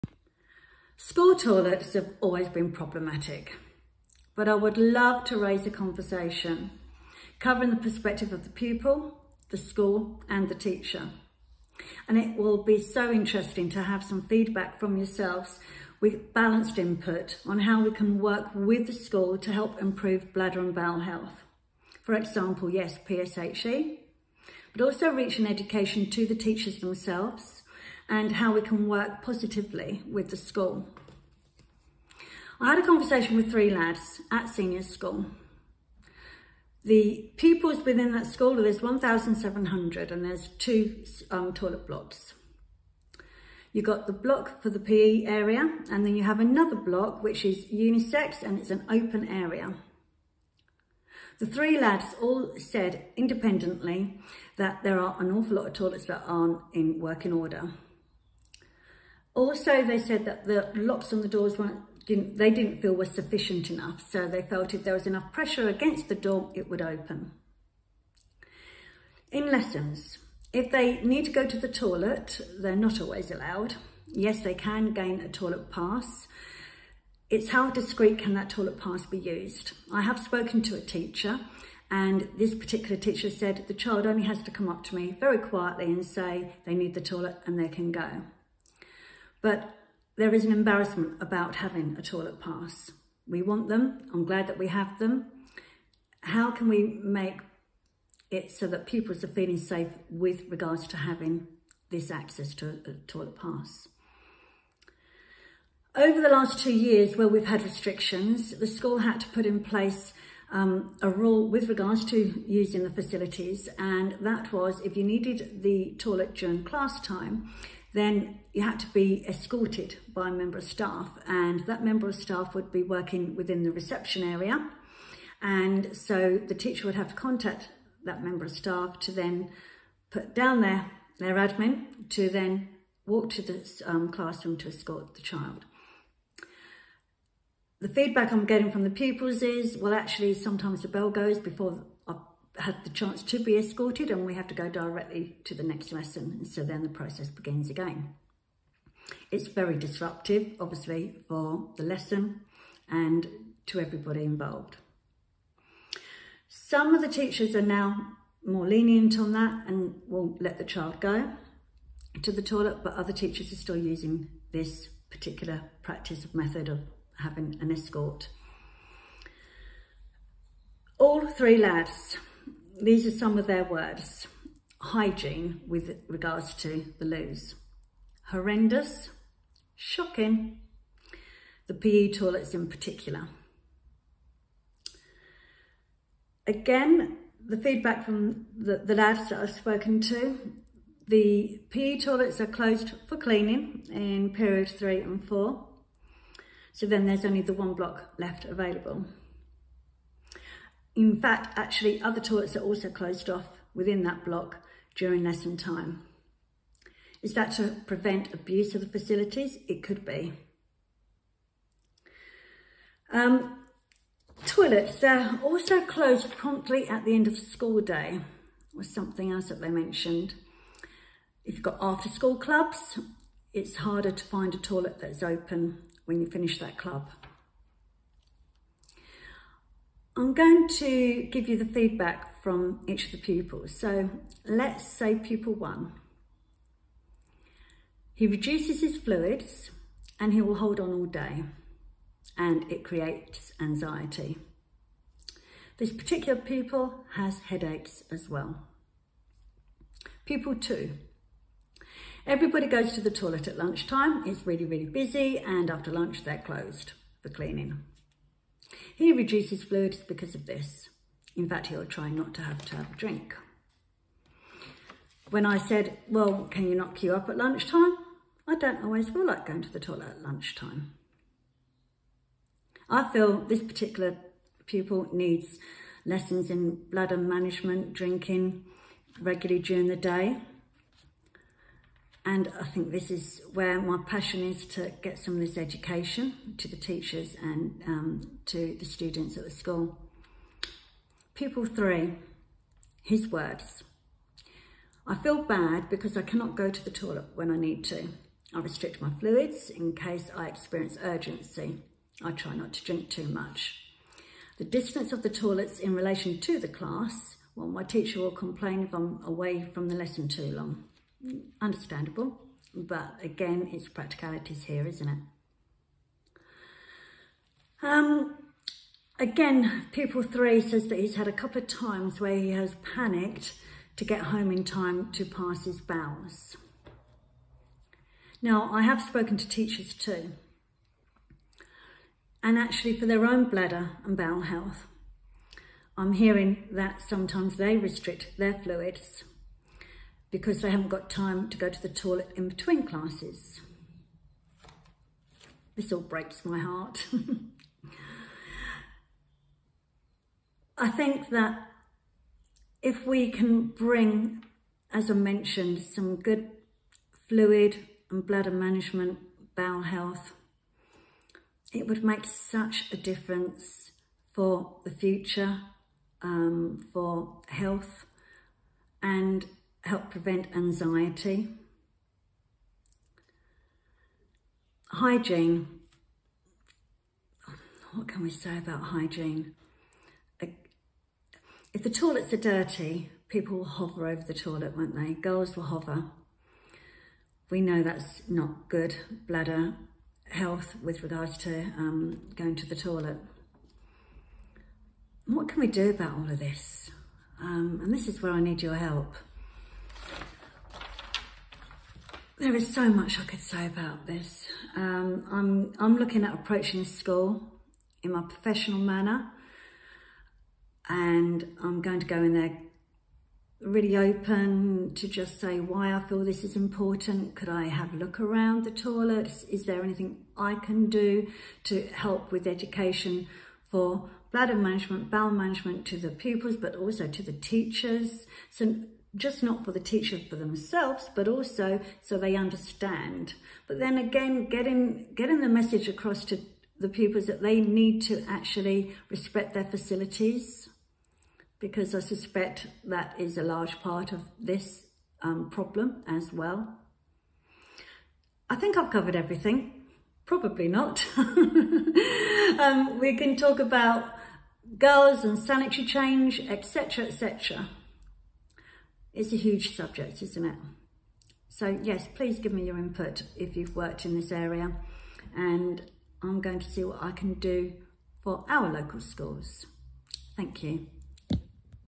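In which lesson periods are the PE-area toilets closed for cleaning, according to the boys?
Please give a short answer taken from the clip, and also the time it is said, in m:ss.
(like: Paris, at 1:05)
Periods 3 and 4, at 3:14.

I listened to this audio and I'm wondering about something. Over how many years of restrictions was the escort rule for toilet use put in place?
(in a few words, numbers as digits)
2.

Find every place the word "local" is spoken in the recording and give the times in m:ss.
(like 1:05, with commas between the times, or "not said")
7:48.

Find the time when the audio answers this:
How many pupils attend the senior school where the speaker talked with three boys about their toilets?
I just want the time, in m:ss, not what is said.
0:38.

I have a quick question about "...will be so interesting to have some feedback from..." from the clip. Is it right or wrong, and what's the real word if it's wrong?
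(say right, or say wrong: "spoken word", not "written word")
right.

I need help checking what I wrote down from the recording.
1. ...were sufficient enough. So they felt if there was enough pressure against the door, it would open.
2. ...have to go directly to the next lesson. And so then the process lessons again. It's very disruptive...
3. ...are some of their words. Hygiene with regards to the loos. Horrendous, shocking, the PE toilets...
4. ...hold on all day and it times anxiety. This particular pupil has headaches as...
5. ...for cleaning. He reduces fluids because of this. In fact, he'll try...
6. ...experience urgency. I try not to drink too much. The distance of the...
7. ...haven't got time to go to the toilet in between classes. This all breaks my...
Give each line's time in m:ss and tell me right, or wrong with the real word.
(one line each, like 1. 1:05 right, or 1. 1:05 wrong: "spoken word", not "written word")
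1. 1:02 right
2. 2:24 wrong: "begins", not "lessons"
3. 2:53 right
4. 4:00 wrong: "creates", not "times"
5. 4:17 right
6. 5:00 right
7. 5:40 right.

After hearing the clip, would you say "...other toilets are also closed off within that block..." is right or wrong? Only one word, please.
right.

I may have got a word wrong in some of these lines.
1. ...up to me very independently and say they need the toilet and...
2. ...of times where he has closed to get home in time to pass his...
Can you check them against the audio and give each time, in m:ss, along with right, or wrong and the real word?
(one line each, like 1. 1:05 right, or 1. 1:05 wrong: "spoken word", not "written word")
1. 1:24 wrong: "quietly", not "independently"
2. 5:21 wrong: "panicked", not "closed".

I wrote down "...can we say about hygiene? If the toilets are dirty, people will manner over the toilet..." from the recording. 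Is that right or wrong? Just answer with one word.
wrong.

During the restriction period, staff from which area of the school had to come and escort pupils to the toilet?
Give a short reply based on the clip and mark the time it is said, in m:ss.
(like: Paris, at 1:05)
Reception, at 2:03.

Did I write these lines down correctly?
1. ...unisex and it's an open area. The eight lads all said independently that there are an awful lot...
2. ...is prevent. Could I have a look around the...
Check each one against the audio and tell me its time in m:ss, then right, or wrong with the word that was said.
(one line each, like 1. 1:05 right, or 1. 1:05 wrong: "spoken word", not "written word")
1. 0:47 wrong: "three", not "eight"
2. 6:56 wrong: "important", not "prevent".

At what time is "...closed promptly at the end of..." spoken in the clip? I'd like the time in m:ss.
3:35.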